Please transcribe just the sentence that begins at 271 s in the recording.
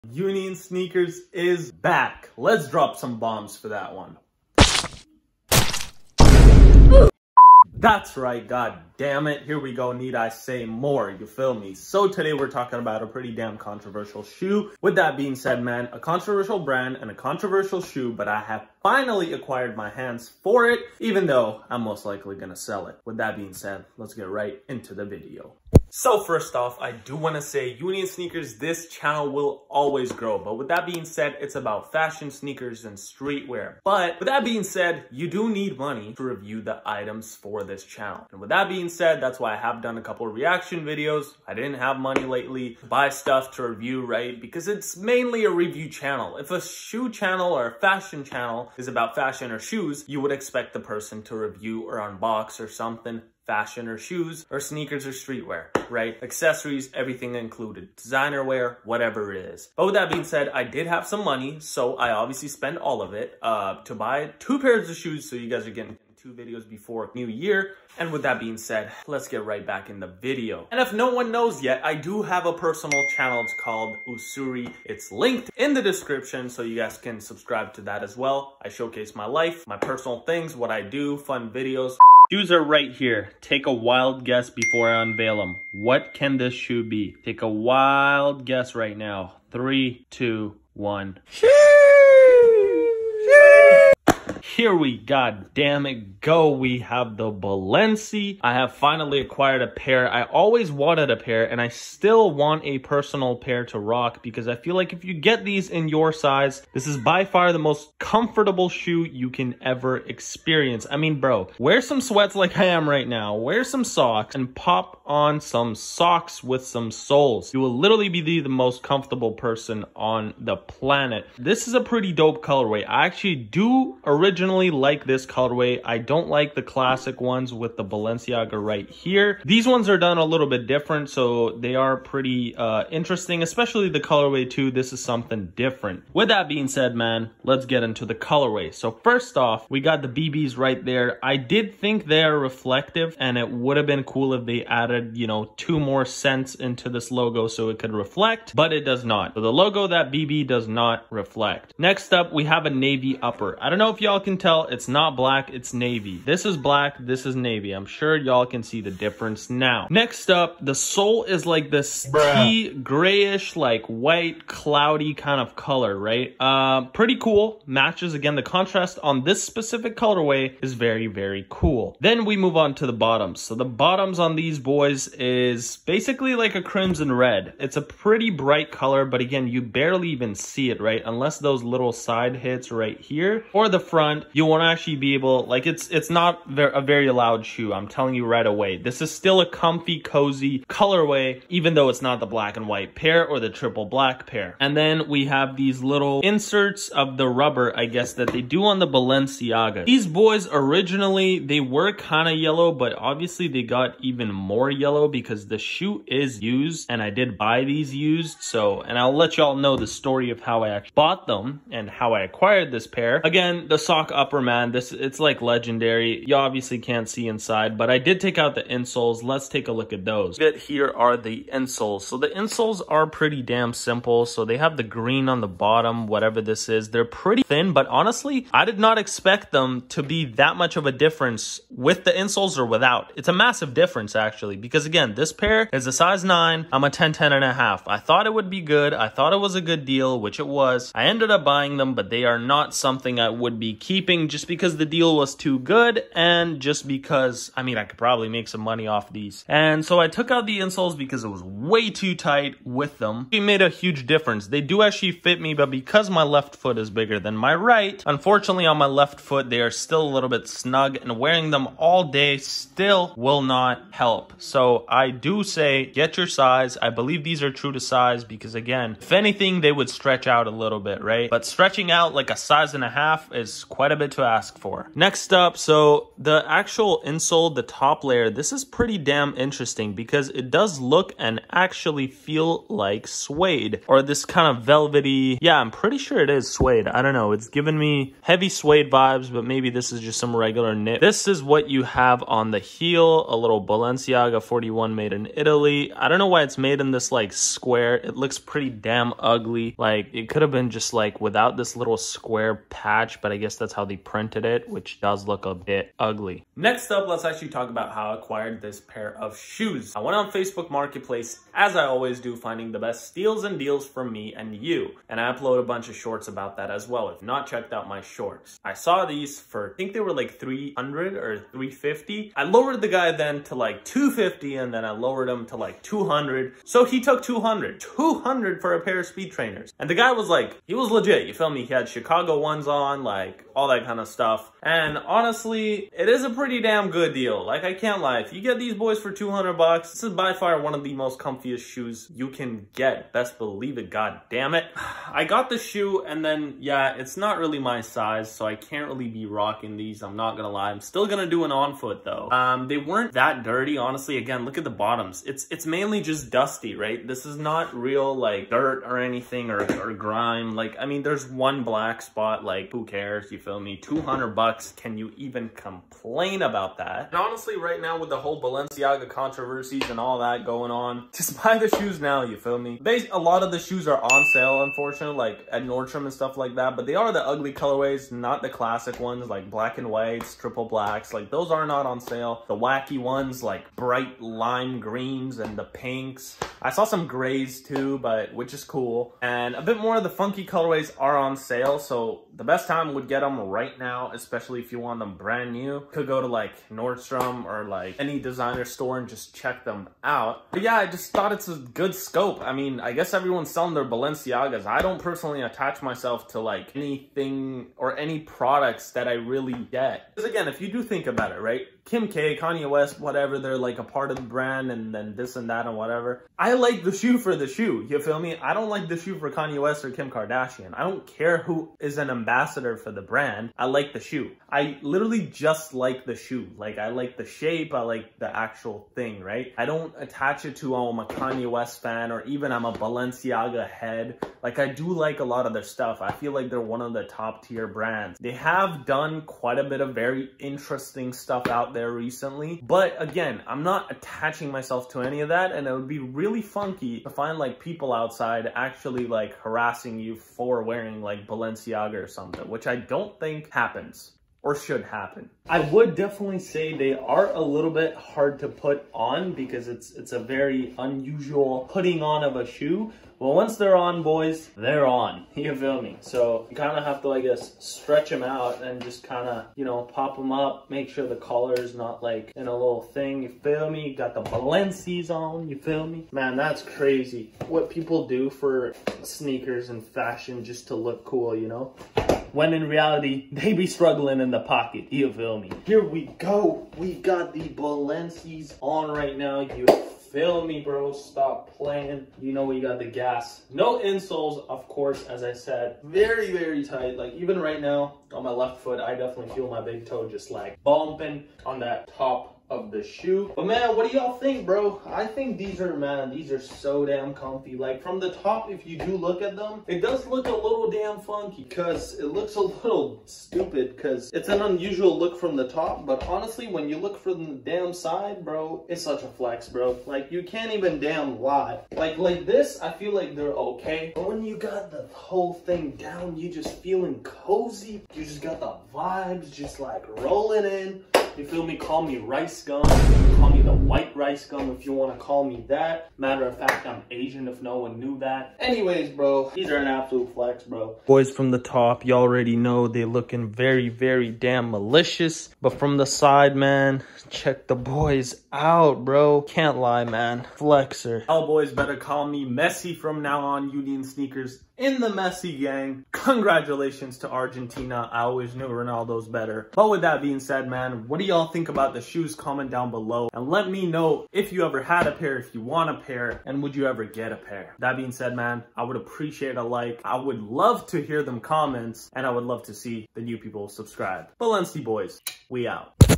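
But stretching out like a size and a half is quite quite a bit to ask for.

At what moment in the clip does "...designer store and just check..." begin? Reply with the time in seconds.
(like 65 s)
398 s.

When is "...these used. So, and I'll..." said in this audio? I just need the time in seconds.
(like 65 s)
207 s.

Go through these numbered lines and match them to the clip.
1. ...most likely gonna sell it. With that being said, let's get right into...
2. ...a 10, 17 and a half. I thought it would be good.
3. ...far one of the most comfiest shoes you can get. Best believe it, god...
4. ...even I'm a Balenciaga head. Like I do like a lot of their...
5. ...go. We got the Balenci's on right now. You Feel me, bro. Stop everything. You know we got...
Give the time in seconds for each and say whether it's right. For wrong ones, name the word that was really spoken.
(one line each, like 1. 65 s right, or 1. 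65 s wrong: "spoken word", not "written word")
1. 21 s right
2. 236 s wrong: "10", not "17"
3. 340 s right
4. 432 s right
5. 486 s wrong: "playing", not "everything".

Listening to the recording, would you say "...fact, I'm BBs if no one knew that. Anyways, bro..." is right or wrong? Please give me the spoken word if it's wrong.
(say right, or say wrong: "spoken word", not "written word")
wrong: "Asian", not "BBs".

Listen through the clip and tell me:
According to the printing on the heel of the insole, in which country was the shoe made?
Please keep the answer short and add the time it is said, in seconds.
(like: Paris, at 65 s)
Italy, at 294 s.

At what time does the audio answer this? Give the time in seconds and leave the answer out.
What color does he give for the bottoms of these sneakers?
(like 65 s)
176 s.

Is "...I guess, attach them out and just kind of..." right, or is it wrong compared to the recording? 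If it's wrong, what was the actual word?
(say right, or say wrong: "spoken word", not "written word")
wrong: "stretch", not "attach".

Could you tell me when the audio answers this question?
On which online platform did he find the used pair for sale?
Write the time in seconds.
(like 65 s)
310 s.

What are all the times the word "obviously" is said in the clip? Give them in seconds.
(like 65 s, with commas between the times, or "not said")
62 s, 202 s, 216 s.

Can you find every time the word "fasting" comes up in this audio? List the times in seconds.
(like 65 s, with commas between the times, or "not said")
not said.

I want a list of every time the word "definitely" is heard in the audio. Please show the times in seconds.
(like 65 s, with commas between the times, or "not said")
455 s, 498 s.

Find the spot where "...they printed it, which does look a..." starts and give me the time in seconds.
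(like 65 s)
303 s.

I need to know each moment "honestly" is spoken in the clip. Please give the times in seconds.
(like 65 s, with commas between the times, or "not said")
227 s, 334 s, 353 s, 367 s, 516 s.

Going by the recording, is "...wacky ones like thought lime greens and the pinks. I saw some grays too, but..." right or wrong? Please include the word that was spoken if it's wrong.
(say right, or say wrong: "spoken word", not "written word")
wrong: "bright", not "thought".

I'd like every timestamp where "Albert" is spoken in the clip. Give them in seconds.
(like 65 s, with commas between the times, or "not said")
not said.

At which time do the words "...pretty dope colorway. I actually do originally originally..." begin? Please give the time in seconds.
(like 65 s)
121 s.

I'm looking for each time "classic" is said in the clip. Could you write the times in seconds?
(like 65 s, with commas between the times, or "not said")
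126 s, 378 s.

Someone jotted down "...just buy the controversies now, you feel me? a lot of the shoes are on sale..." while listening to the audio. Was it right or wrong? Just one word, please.
wrong.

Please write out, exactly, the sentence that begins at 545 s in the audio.
But from the side, man, check the boys out, bro.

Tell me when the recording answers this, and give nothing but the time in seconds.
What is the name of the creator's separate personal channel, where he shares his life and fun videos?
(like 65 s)
74 s.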